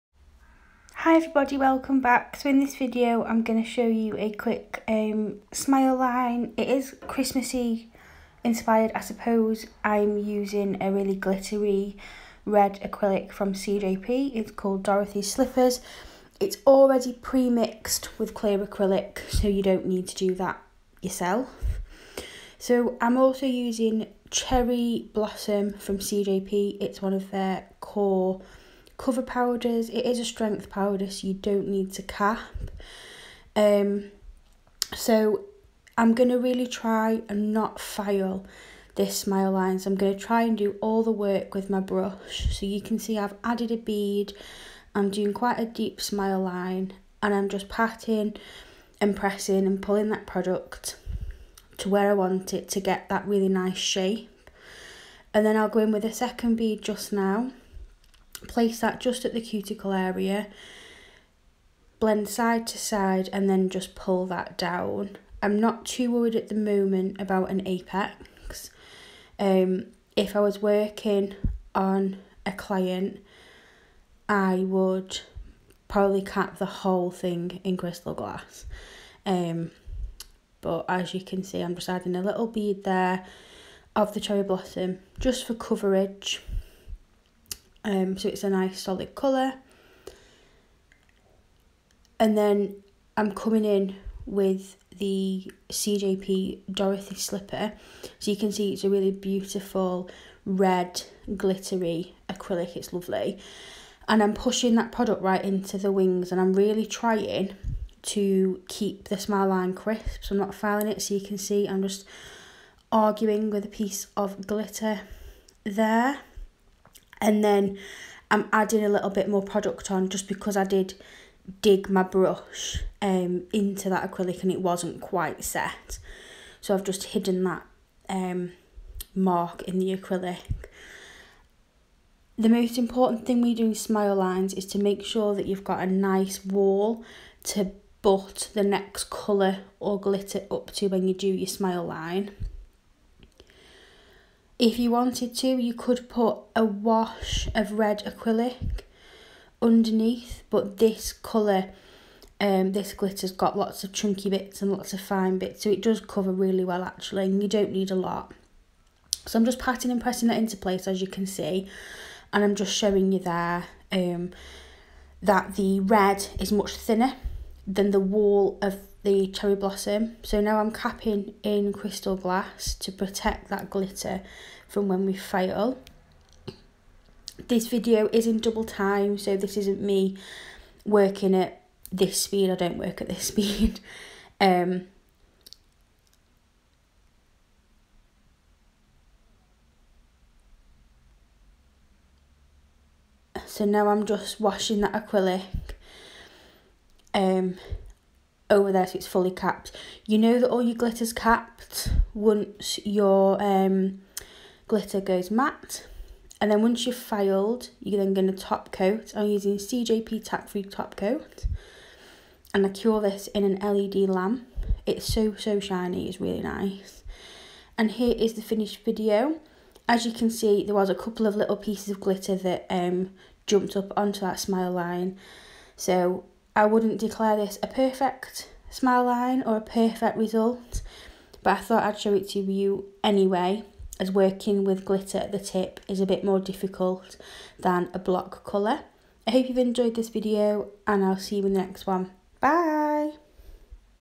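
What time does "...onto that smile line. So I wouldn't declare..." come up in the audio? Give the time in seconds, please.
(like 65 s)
223 s.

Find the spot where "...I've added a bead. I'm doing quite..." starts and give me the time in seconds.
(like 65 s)
43 s.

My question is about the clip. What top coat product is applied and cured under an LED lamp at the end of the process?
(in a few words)
CJP Tack Free Top Coat.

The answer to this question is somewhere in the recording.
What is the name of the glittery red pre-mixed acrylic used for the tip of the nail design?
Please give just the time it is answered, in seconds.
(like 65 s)
14 s.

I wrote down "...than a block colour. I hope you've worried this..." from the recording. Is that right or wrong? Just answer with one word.
wrong.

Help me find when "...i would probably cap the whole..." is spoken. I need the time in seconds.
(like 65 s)
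74 s.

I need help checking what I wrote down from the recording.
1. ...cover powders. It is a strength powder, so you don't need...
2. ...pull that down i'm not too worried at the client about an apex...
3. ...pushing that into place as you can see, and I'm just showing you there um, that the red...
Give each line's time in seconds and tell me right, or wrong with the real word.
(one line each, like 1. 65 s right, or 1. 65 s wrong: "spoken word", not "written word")
1. 29 s right
2. 63 s wrong: "moment", not "client"
3. 159 s wrong: "pressing", not "pushing".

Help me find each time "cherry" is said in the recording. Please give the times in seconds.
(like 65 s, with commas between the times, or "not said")
24 s, 84 s, 169 s.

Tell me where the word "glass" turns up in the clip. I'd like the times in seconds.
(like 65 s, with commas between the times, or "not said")
78 s, 172 s.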